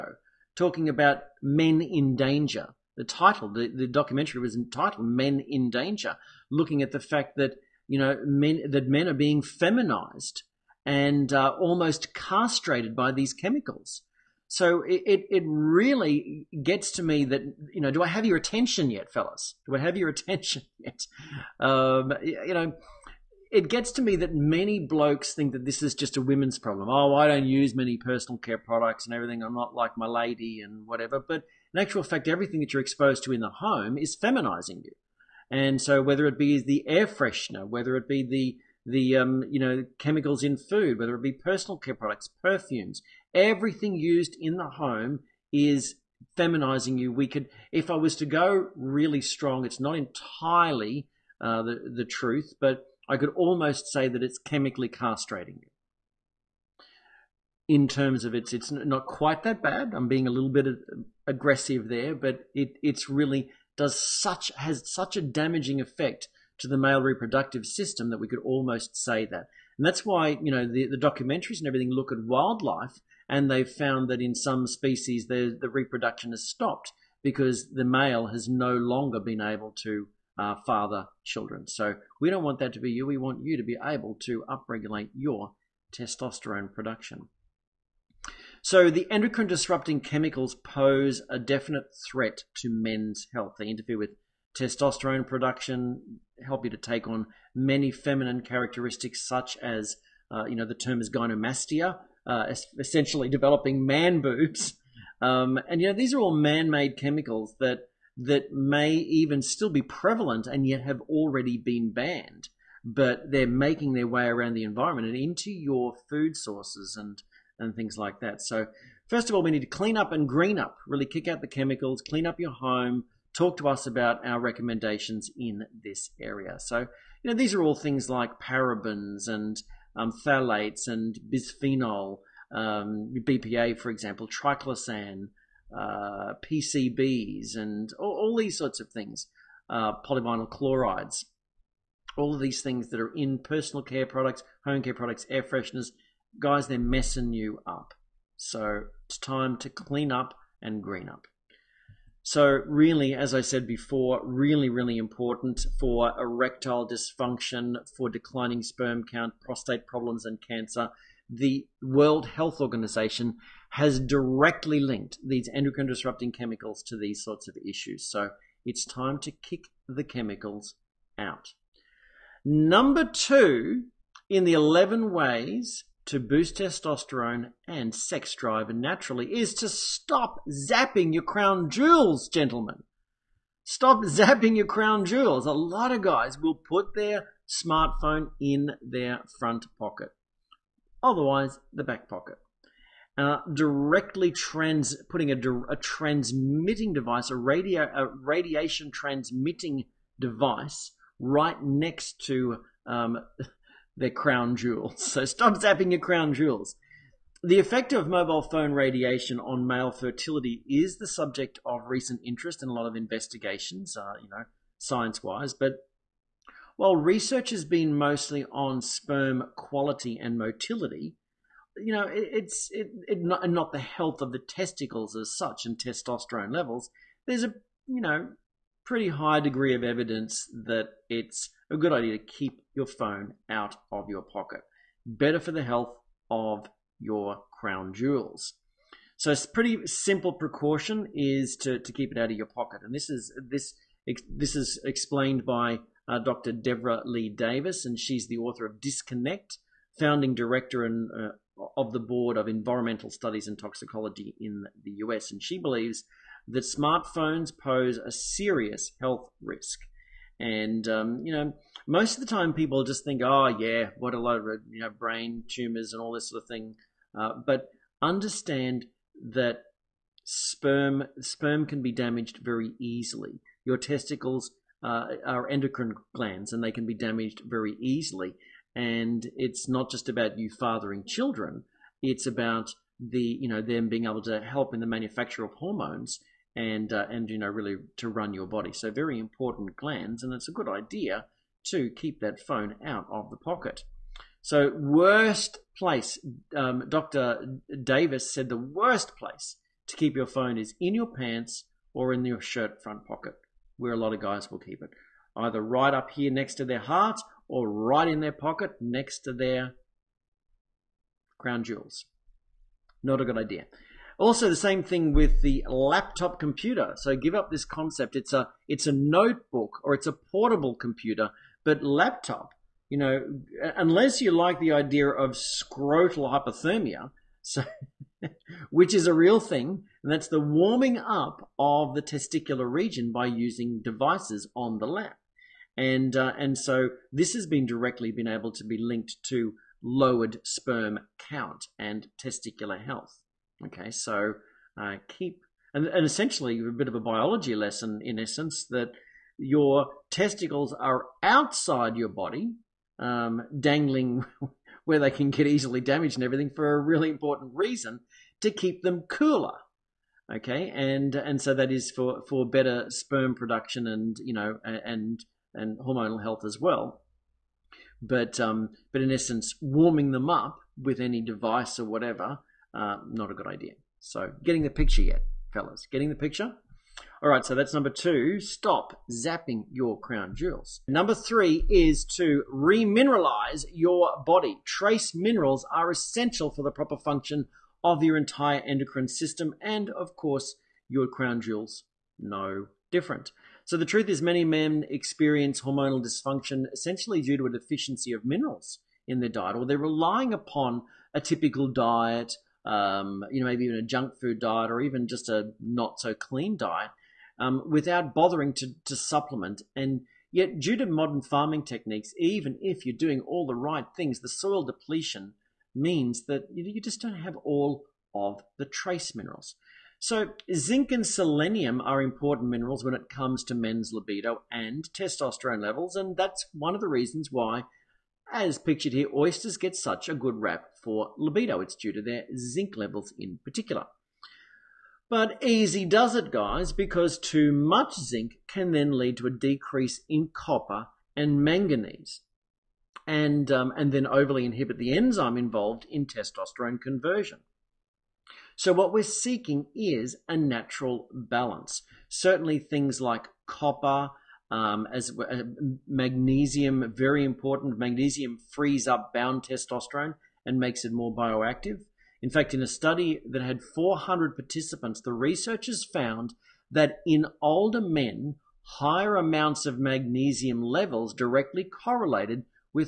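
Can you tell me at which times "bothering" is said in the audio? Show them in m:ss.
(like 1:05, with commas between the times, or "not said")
6:48.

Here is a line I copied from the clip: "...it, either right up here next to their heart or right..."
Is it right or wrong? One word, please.
right.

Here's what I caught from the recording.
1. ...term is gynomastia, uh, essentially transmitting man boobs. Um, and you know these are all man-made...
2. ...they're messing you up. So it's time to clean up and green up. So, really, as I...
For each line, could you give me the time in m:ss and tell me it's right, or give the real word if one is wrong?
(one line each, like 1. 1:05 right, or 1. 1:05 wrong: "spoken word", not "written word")
1. 1:40 wrong: "developing", not "transmitting"
2. 2:26 right.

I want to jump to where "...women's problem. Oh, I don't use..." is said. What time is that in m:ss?
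0:26.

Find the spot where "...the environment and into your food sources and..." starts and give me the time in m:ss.
1:54.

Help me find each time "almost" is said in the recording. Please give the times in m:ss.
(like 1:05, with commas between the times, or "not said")
0:11, 0:53, 1:08.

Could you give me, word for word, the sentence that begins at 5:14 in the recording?
Also, the same thing with the laptop computer.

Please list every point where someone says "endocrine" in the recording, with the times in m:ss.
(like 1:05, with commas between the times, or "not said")
1:29, 2:45, 4:35, 6:28.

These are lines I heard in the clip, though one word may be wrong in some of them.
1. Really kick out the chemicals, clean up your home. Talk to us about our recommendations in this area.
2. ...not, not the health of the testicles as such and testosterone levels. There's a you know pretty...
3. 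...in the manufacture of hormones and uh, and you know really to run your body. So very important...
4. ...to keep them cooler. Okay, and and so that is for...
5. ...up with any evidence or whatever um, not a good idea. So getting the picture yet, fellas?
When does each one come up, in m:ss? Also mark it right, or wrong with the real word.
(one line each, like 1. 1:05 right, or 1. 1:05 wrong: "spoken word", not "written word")
1. 2:00 right
2. 3:43 right
3. 4:44 right
4. 5:58 right
5. 6:10 wrong: "device", not "evidence".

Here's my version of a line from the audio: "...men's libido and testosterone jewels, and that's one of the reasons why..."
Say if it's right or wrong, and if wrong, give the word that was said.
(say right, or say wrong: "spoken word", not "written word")
wrong: "levels", not "jewels".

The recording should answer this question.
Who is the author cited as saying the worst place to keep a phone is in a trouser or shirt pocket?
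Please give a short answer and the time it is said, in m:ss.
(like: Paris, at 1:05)
Dr. Devra Lee Davis, at 4:06.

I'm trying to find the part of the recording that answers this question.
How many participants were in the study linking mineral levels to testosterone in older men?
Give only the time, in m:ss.
7:43.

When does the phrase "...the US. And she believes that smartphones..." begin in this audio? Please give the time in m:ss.
4:14.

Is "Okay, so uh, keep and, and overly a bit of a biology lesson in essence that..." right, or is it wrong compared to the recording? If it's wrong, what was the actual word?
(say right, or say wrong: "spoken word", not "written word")
wrong: "essentially", not "overly".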